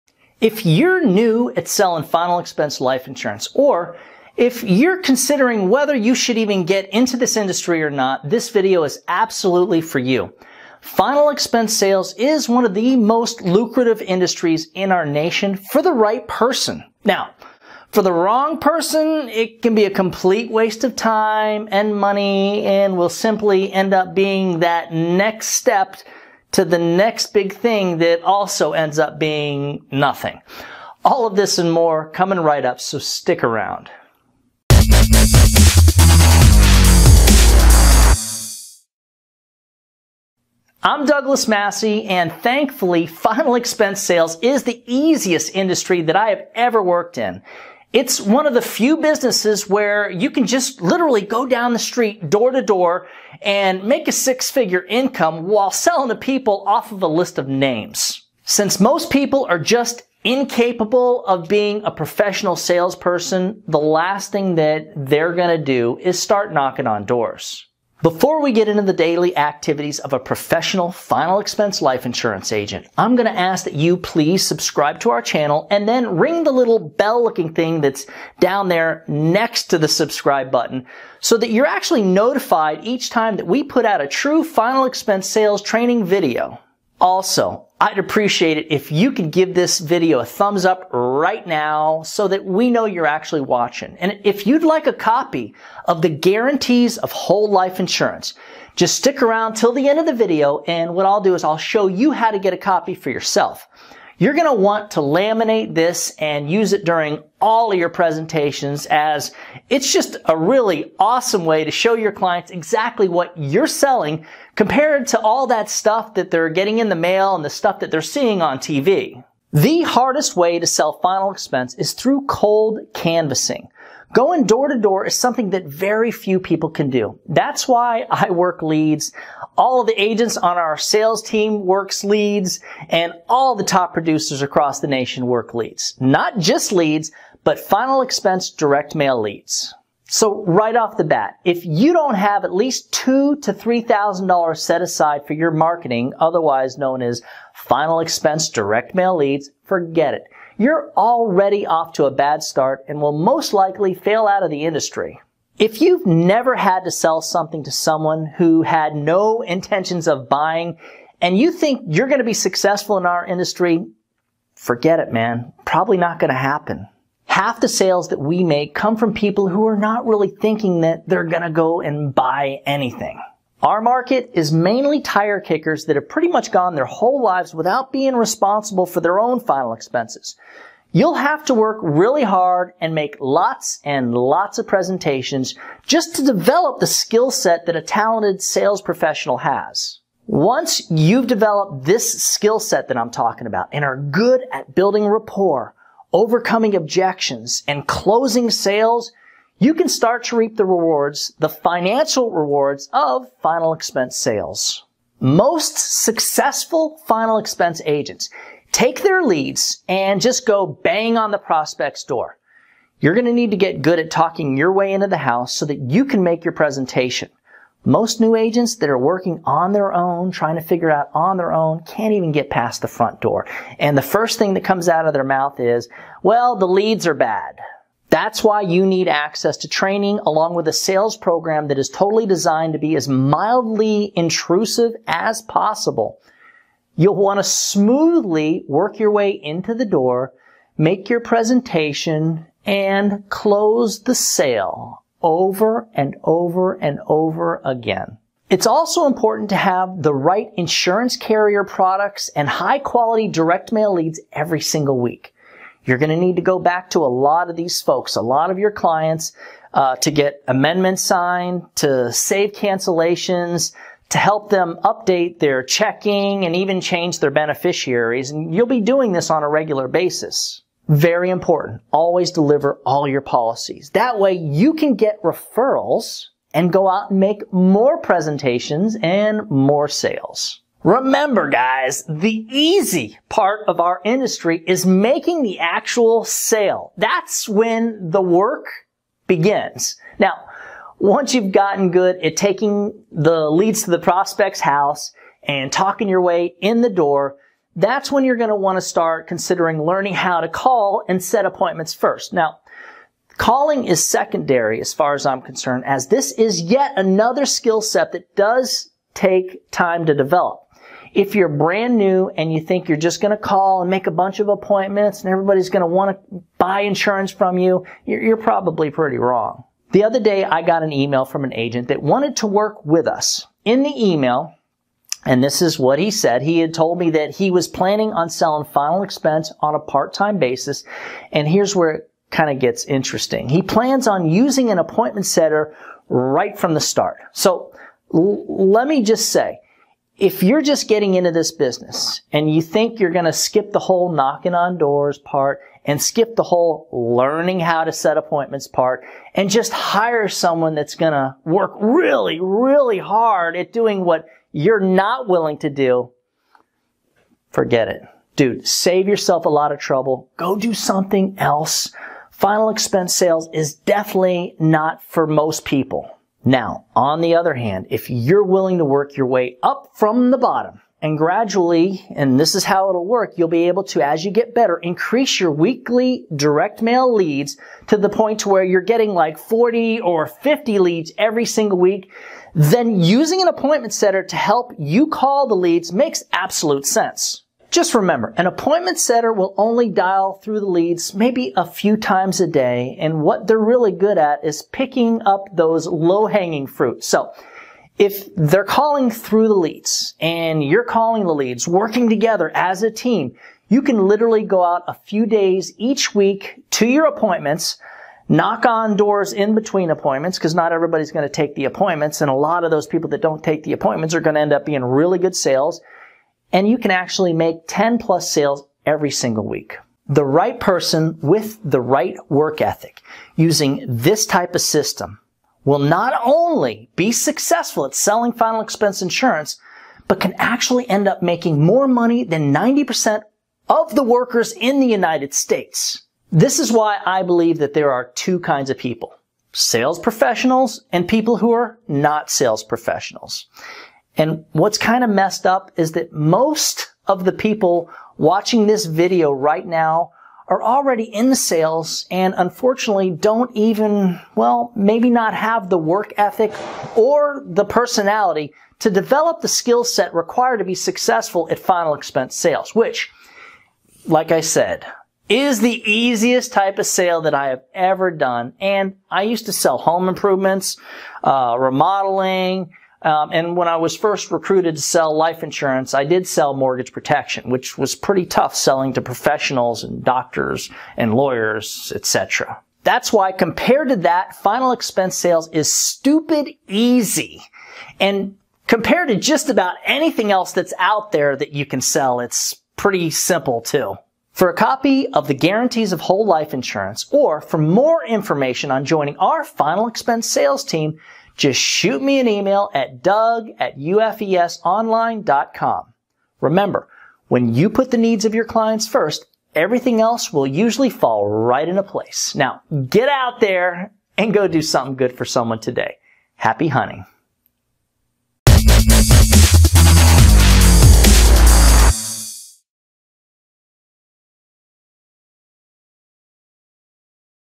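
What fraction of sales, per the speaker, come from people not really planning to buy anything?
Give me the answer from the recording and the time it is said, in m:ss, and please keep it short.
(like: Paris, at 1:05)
Half, at 2:47.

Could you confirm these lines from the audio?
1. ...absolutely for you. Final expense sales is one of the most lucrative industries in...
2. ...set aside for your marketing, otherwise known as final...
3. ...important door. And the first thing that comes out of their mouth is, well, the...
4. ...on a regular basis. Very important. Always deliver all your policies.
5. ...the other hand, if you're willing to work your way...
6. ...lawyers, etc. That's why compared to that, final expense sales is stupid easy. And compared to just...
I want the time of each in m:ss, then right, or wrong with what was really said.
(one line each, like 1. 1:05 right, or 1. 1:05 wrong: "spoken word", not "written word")
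1. 0:09 right
2. 2:24 right
3. 3:42 wrong: "front", not "important"
4. 4:29 right
5. 6:07 right
6. 8:01 right.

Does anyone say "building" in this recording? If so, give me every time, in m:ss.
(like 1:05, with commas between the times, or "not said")
3:14.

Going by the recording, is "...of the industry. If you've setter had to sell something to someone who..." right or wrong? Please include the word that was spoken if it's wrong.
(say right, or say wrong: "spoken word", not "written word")
wrong: "never", not "setter".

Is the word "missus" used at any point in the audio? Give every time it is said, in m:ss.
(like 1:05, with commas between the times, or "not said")
not said.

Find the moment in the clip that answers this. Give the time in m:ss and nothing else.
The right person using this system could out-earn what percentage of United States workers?
7:12.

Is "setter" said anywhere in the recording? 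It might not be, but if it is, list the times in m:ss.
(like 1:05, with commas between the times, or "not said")
5:35, 6:23, 6:28.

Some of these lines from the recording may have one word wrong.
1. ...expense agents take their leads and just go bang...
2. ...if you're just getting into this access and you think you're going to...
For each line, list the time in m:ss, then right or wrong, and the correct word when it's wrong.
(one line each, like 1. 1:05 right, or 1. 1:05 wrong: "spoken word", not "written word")
1. 3:27 right
2. 5:40 wrong: "business", not "access".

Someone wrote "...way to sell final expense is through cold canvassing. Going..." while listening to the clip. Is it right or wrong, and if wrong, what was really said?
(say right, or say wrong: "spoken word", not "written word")
right.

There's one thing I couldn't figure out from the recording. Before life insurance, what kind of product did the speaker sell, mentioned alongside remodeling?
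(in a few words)
Home improvements.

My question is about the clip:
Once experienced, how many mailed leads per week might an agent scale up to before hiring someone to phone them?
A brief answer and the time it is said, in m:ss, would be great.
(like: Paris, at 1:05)
40 or 50, at 6:19.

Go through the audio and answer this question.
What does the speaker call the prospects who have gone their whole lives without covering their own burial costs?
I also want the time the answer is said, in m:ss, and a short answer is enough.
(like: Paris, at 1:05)
Tire kickers, at 2:54.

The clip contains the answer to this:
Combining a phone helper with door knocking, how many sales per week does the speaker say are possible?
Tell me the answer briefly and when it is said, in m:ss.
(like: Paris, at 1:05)
10 plus, at 6:57.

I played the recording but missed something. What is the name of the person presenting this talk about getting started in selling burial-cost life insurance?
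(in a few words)
Douglas Massi.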